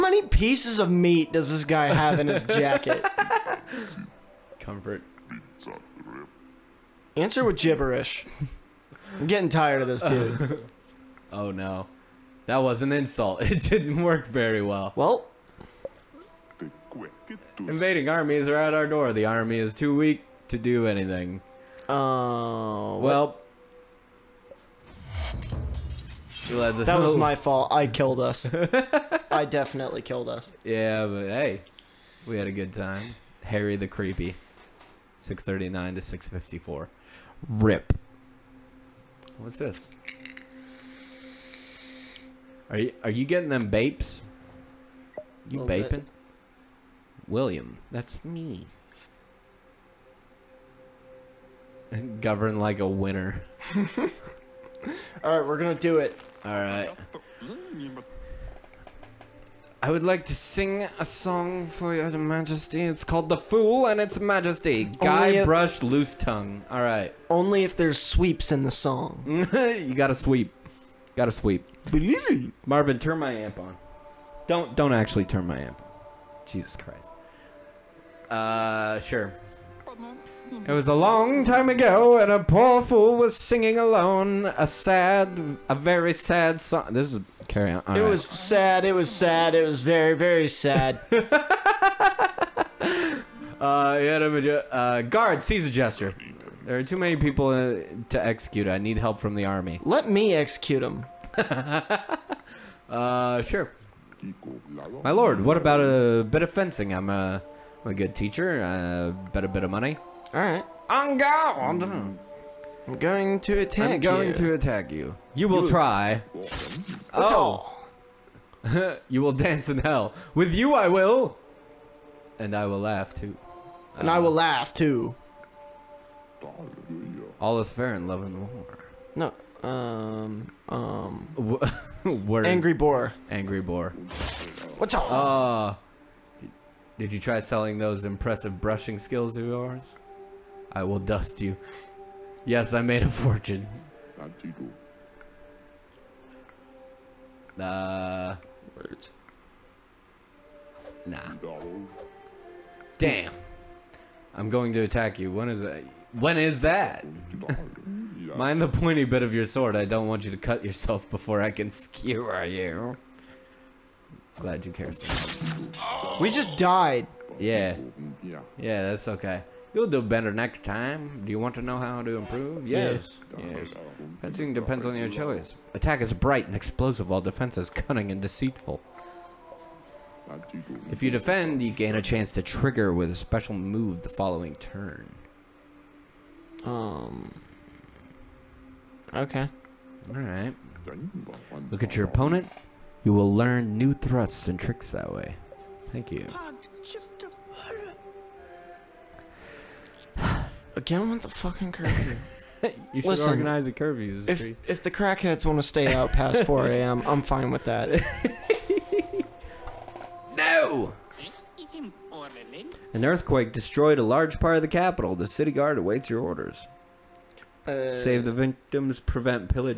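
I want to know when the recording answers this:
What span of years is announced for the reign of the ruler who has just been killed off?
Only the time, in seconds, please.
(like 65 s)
35 s.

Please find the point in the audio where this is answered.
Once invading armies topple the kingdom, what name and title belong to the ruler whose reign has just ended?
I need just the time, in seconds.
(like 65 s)
33 s.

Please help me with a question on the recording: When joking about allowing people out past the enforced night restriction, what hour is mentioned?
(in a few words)
4 a.m.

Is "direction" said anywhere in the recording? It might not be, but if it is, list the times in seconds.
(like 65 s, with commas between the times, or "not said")
not said.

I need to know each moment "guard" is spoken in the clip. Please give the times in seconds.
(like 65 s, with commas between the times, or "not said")
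95 s, 215 s.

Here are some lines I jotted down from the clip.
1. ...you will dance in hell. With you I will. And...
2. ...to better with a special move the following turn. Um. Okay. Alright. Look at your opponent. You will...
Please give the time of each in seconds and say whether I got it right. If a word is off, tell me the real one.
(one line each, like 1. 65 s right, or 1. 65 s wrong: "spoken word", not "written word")
1. 119 s right
2. 182 s wrong: "trigger", not "better".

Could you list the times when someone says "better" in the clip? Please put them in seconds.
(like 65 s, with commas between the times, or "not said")
170 s.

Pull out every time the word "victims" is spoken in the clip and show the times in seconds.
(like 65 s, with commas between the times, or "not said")
218 s.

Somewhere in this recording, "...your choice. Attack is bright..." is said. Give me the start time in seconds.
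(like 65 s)
174 s.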